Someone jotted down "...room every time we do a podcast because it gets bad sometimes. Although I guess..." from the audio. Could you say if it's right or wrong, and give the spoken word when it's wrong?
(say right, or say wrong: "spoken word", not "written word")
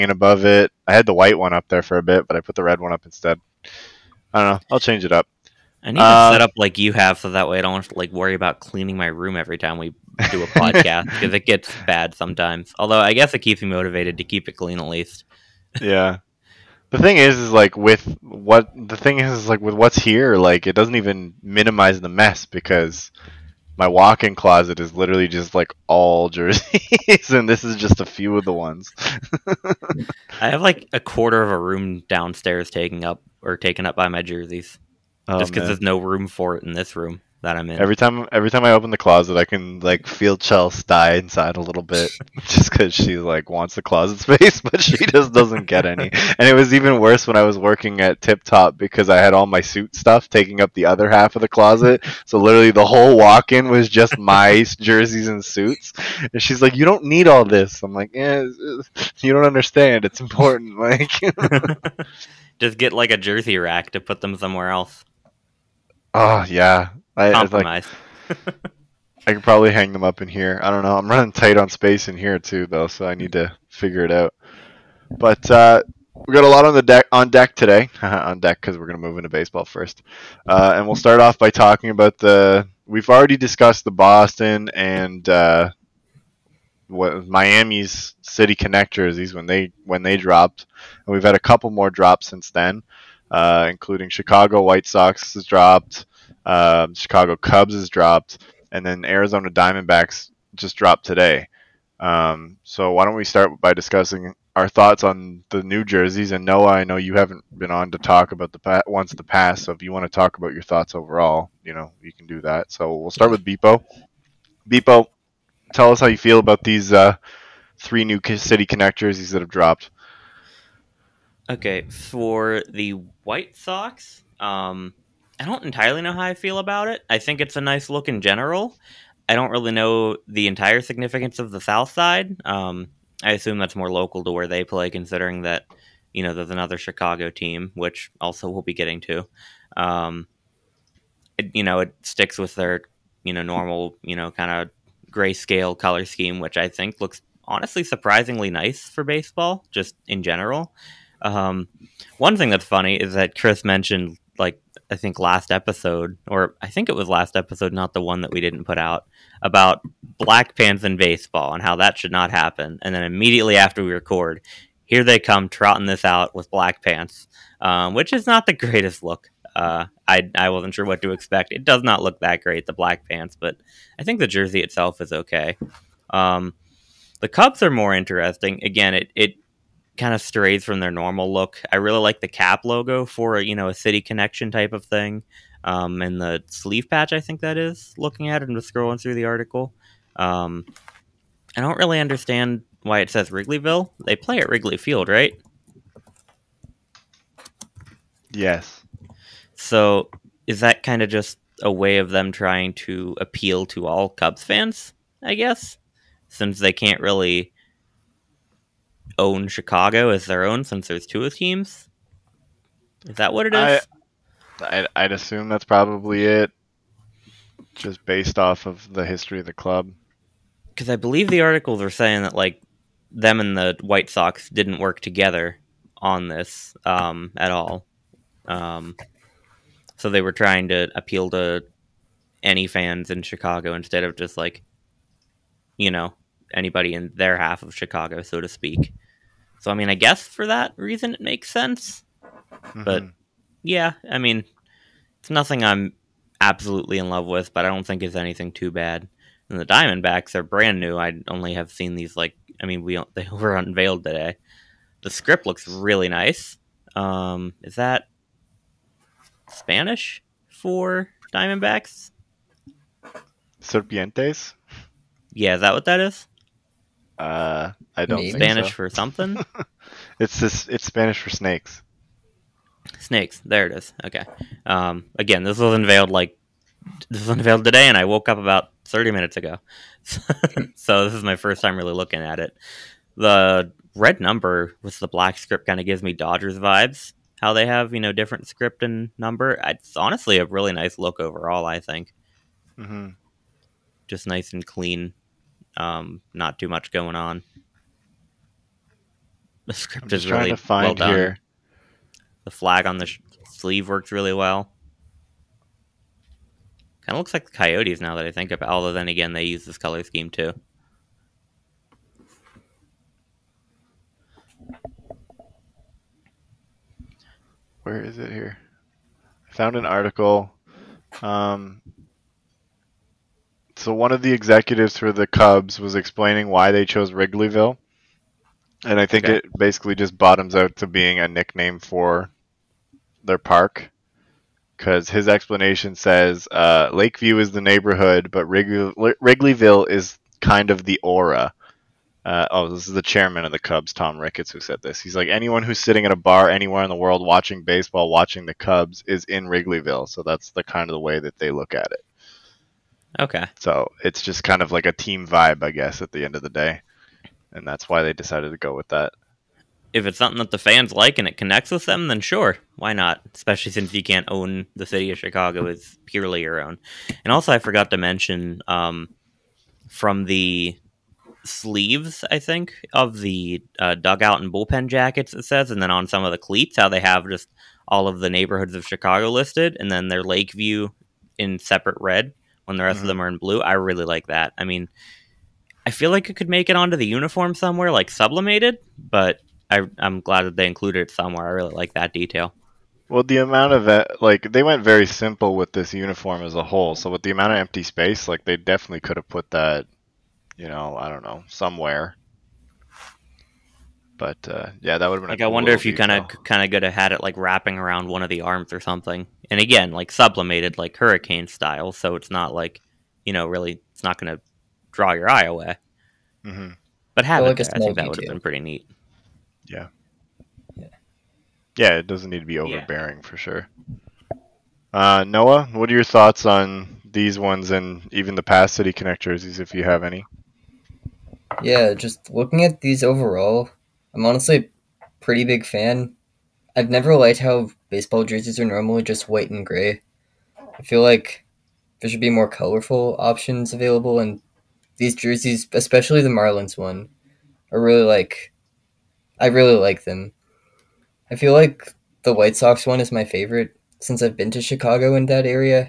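right.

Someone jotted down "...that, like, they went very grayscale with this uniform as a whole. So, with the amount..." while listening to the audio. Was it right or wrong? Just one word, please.
wrong.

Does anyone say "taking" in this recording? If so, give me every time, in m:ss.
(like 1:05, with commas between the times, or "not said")
0:32, 0:50.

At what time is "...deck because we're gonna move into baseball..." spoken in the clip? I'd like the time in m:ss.
1:18.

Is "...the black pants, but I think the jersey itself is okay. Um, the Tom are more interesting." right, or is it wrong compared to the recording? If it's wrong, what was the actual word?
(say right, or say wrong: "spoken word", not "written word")
wrong: "Cubs", not "Tom".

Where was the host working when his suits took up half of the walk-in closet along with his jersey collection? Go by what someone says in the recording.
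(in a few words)
Tip Top.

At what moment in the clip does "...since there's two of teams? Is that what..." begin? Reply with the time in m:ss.
3:30.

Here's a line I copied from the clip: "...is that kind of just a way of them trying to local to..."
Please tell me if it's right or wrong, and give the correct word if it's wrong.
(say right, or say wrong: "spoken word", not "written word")
wrong: "appeal", not "local".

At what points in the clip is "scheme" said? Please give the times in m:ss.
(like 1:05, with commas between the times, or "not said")
2:26, 5:10.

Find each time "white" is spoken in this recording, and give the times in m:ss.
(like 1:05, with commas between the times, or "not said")
0:01, 1:34, 2:03, 3:43, 7:19, 7:32.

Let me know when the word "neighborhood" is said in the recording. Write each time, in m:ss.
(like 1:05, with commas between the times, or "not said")
5:37, 6:18.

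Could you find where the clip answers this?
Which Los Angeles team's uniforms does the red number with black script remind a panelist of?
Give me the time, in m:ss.
4:46.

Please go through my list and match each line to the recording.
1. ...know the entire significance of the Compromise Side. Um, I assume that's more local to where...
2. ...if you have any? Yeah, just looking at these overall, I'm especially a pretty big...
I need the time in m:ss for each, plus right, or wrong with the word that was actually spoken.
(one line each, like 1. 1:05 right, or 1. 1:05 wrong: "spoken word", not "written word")
1. 2:09 wrong: "South", not "Compromise"
2. 7:09 wrong: "honestly", not "especially".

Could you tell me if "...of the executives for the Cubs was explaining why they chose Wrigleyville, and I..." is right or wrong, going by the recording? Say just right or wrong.
right.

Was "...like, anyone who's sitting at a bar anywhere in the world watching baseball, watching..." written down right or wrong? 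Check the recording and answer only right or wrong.
right.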